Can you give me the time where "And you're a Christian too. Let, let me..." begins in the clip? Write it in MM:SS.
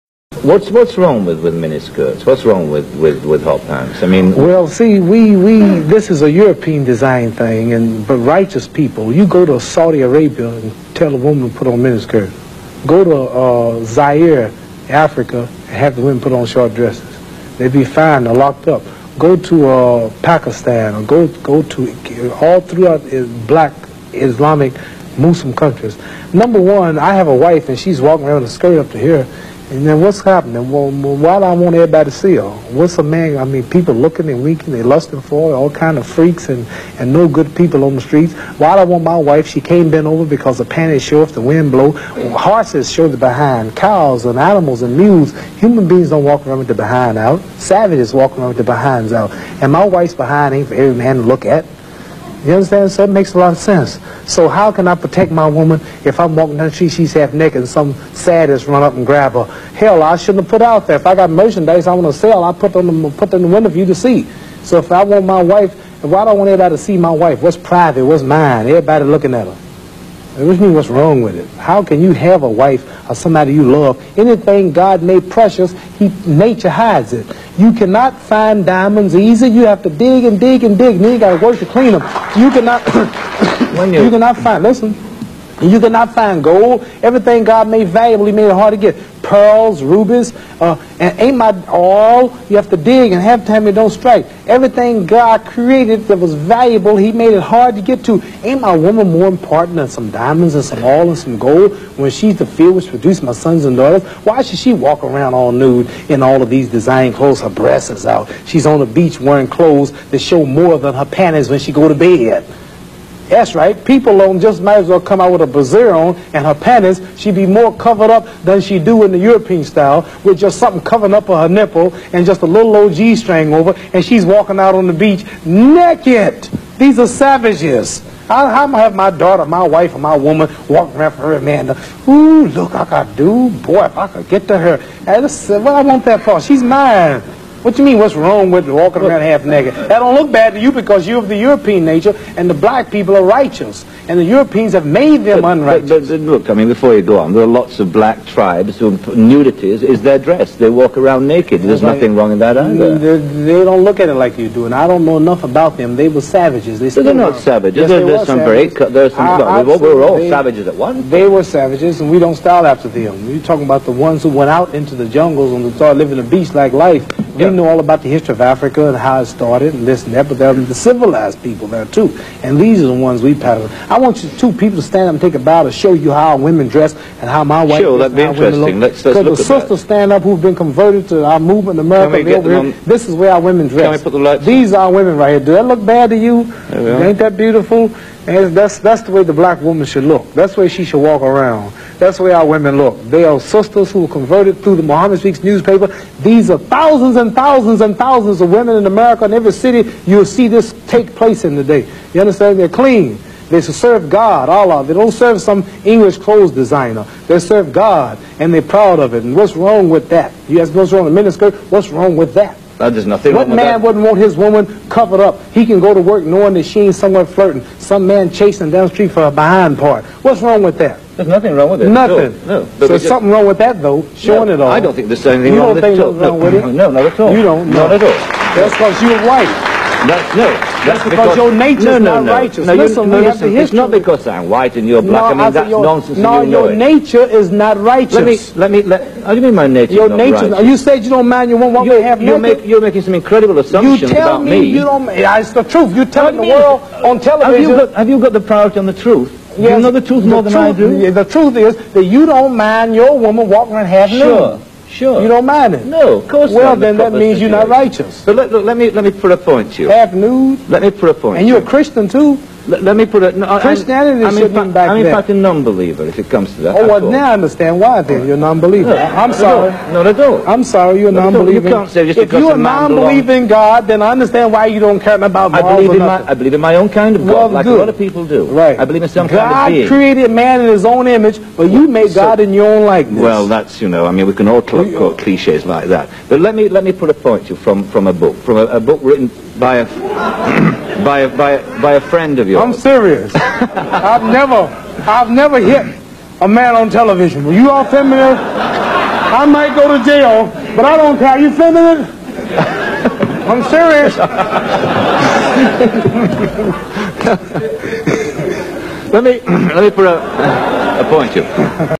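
04:21.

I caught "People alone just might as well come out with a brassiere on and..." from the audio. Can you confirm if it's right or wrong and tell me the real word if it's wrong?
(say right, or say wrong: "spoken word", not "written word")
right.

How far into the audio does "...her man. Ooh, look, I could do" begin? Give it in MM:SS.
02:11.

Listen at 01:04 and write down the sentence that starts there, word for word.
So if I want my wife, why don't I want everybody to see my wife?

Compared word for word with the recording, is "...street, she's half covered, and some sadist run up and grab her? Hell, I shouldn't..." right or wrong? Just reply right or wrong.
wrong.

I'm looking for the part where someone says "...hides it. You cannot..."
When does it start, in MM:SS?
01:16.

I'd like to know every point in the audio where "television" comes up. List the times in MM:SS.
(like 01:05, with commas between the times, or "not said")
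04:07, 04:56.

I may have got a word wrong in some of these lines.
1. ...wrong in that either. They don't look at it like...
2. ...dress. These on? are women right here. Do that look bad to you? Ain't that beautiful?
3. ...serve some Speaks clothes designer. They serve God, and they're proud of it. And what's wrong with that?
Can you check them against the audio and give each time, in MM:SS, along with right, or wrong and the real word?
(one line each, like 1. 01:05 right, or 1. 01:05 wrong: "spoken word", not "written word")
1. 02:32 right
2. 03:03 right
3. 03:25 wrong: "English", not "Speaks".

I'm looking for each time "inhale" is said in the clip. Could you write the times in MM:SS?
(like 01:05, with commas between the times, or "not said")
not said.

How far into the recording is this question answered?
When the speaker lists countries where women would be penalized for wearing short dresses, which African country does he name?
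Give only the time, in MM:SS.
00:13.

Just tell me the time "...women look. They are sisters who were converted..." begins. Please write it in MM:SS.
03:12.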